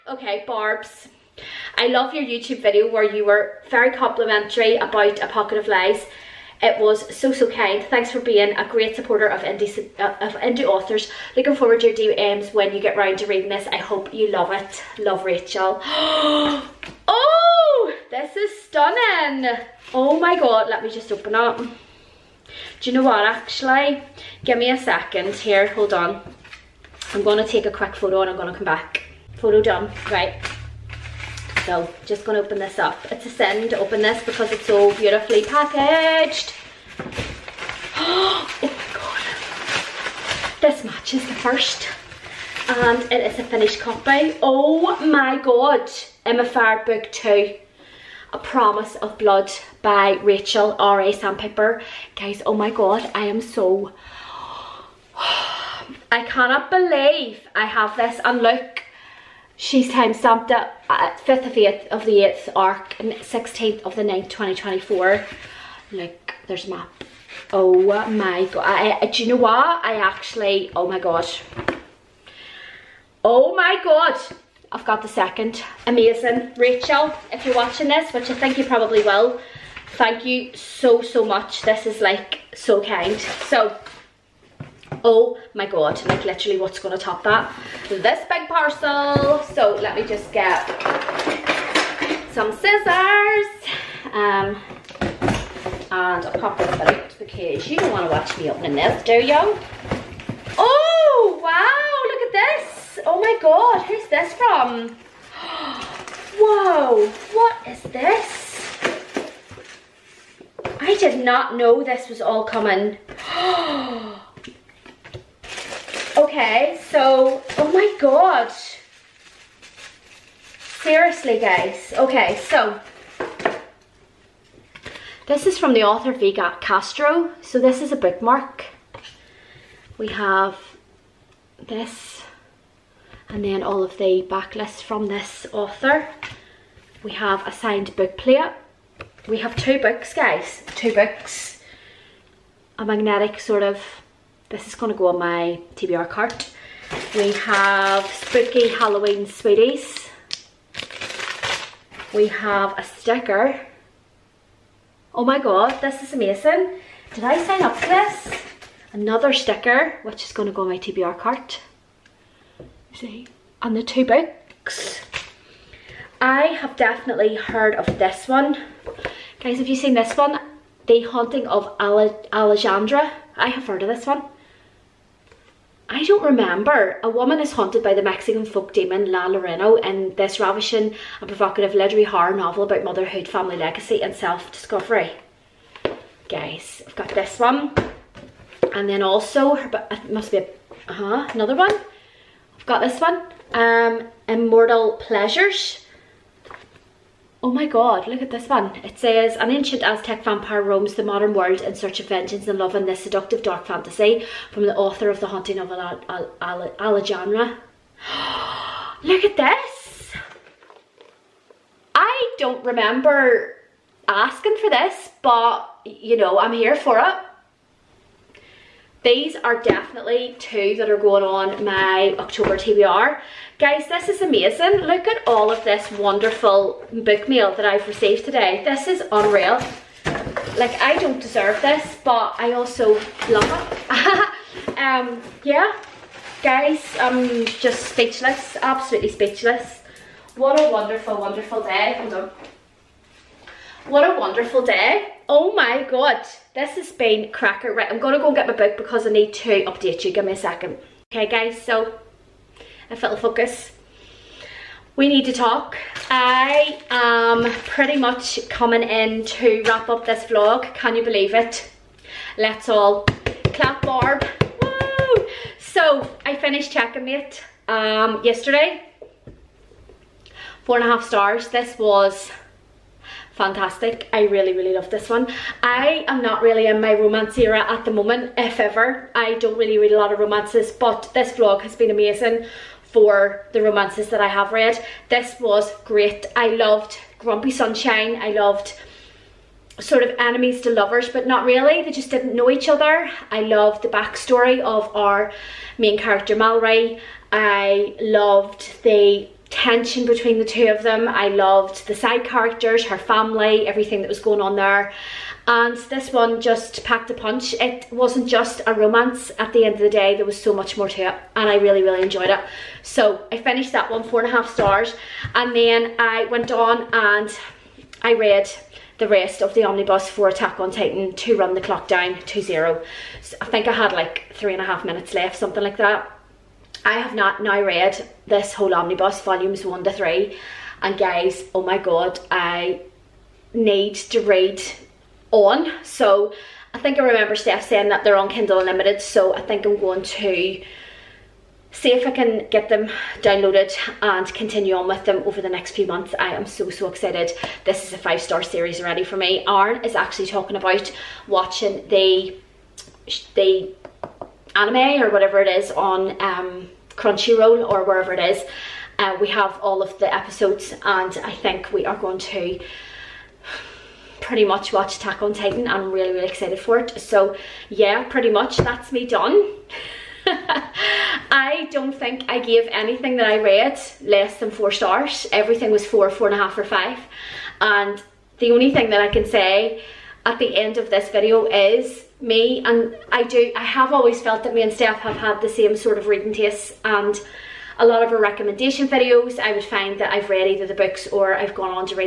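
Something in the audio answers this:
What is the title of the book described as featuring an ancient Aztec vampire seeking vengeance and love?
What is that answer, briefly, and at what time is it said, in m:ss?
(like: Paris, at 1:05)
Immortal Pleasures, at 3:14.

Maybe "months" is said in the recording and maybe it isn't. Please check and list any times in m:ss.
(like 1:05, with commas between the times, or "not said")
5:45.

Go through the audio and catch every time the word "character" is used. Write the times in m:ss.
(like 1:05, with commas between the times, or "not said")
4:55, 5:02.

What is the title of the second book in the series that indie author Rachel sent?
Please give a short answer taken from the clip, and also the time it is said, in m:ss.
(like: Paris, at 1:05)
A Promise of Blood, at 0:48.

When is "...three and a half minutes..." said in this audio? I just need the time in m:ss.
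5:24.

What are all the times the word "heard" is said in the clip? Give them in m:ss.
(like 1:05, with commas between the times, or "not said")
2:47, 2:53.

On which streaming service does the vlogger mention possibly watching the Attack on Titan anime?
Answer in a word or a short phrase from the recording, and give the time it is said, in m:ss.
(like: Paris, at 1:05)
Crunchyroll, at 5:56.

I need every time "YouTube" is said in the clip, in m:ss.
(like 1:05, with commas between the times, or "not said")
0:02.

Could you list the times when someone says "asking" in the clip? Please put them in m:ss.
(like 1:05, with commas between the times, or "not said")
3:34.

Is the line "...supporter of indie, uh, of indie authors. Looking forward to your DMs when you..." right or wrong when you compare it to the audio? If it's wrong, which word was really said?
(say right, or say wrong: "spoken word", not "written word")
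right.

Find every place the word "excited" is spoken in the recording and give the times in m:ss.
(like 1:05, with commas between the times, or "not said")
5:46, 6:06.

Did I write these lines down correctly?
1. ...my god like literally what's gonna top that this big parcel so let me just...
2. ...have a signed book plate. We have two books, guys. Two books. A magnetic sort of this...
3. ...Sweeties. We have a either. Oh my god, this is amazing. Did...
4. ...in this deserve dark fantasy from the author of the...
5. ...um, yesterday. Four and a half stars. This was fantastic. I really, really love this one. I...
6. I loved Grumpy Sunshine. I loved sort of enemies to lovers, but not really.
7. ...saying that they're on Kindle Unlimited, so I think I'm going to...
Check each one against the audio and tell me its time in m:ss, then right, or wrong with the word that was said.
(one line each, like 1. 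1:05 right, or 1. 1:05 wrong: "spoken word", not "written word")
1. 1:25 right
2. 2:17 right
3. 2:29 wrong: "sticker", not "either"
4. 3:22 wrong: "seductive", not "deserve"
5. 4:27 right
6. 4:46 right
7. 5:37 right.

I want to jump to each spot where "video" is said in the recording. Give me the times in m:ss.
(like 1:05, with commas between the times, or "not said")
0:02, 6:21, 6:28.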